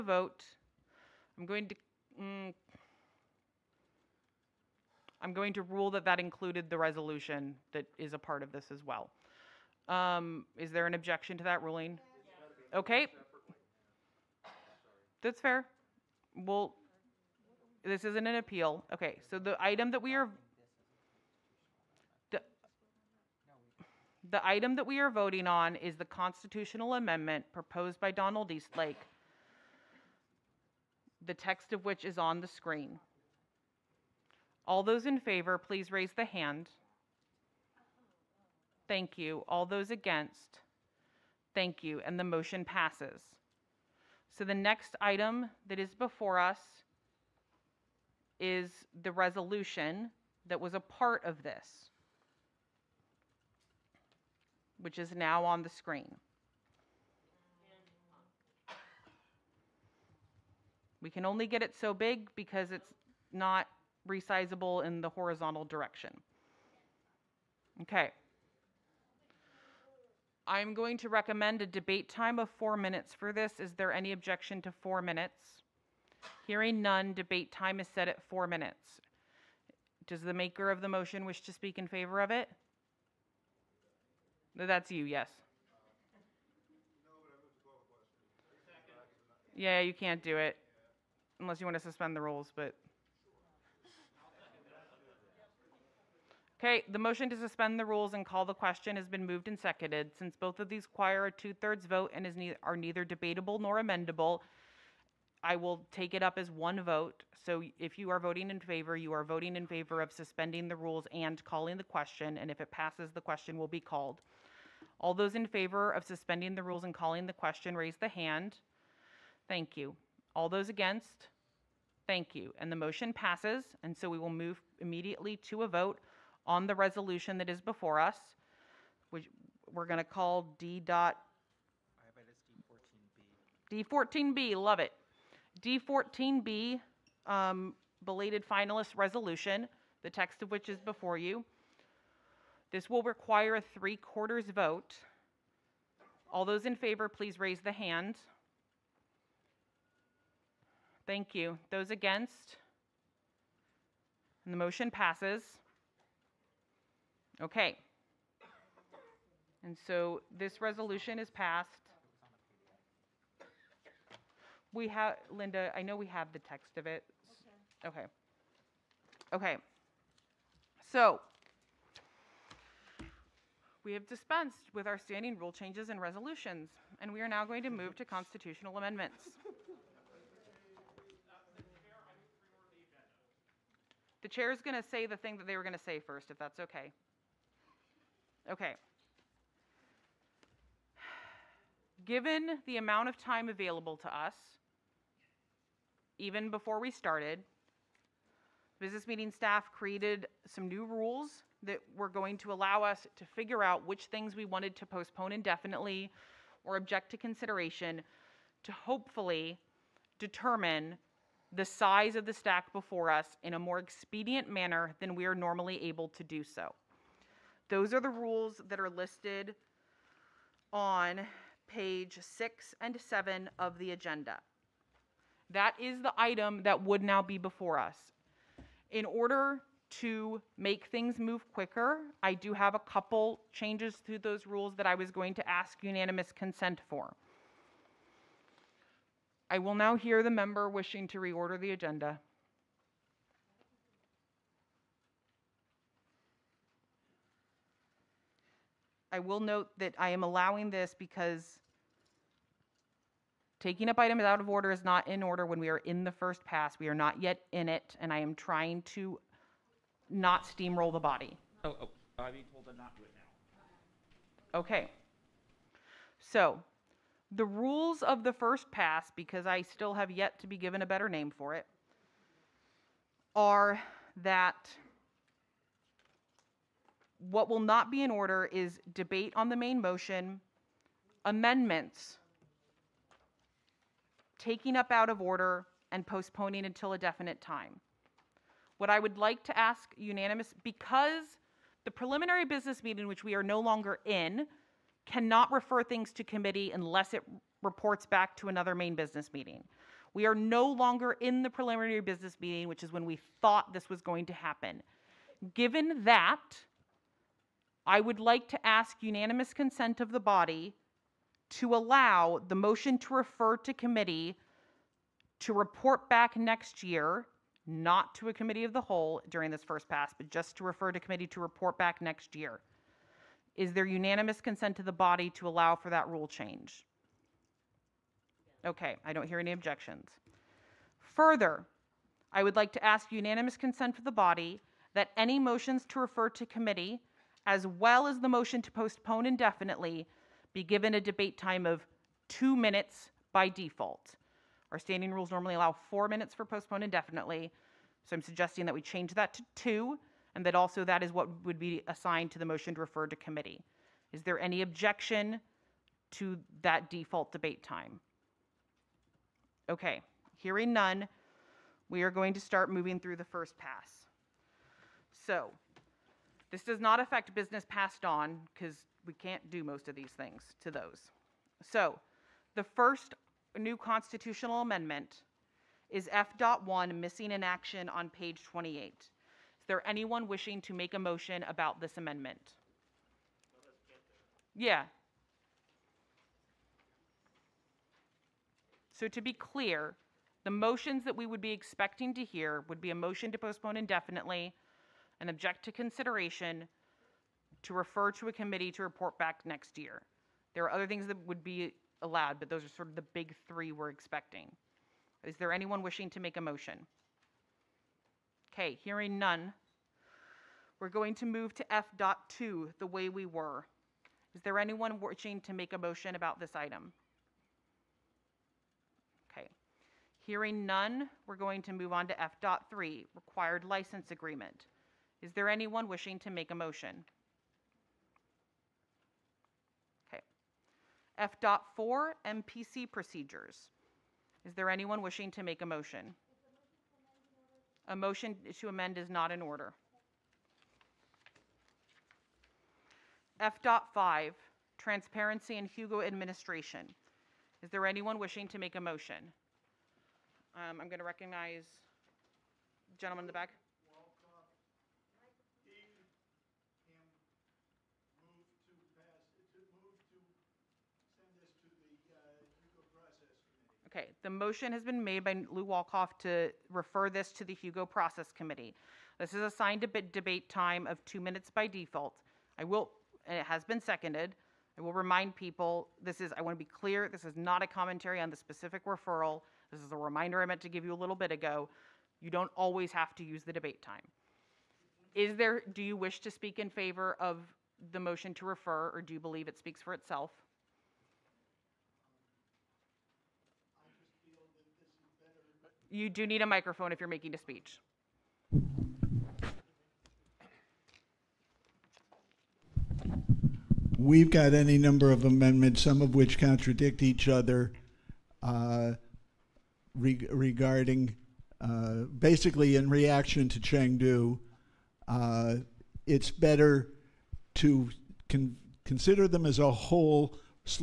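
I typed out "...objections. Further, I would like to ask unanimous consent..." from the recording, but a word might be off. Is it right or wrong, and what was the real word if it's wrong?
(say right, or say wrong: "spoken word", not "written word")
right.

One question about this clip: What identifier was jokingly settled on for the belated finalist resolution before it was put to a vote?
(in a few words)
D14B.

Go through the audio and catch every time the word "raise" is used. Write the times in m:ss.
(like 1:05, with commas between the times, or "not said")
0:35, 1:57, 2:27.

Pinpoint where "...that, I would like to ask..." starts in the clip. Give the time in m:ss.
5:06.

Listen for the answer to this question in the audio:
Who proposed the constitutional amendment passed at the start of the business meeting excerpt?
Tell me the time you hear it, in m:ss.
0:28.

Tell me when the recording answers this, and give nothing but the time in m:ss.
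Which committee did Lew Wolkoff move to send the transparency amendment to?
7:47.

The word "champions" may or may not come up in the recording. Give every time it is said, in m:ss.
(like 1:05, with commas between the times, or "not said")
not said.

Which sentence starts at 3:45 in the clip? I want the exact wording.
That is the item that would now be before us.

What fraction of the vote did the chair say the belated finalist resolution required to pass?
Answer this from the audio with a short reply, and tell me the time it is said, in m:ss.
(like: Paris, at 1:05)
three quarters, at 2:23.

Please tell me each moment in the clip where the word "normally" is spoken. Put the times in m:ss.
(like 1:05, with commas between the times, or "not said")
3:35, 5:45.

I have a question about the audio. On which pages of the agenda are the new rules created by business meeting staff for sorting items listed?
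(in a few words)
pages 6 and 7.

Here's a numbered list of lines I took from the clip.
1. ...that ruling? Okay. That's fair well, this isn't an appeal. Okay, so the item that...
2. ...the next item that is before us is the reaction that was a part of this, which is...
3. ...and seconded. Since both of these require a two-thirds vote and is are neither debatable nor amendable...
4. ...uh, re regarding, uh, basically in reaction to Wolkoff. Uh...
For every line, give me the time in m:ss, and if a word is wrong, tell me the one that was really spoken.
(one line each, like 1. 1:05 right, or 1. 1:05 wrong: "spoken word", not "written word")
1. 0:11 right
2. 0:44 wrong: "resolution", not "reaction"
3. 1:39 right
4. 8:28 wrong: "Chengdu", not "Wolkoff".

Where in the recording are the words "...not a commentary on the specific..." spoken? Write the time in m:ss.
7:57.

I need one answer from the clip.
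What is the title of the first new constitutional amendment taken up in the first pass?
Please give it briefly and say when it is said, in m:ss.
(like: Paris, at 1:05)
Missing in Action, at 6:16.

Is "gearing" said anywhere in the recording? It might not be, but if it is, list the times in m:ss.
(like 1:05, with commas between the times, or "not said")
not said.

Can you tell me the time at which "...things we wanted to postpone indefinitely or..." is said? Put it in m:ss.
3:24.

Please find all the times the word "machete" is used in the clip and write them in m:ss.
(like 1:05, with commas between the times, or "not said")
not said.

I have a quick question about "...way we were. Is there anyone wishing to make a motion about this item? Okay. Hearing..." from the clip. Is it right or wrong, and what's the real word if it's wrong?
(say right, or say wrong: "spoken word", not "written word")
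right.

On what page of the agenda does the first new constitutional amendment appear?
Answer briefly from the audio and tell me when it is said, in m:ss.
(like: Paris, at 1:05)
28, at 6:18.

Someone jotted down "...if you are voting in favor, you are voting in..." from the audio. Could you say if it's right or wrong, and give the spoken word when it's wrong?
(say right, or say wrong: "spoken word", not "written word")
right.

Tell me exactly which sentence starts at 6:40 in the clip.
There are other things that would be allowed, but those are sort of the big three we're expecting.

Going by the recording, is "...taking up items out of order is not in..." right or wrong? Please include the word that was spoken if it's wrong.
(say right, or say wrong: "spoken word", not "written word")
right.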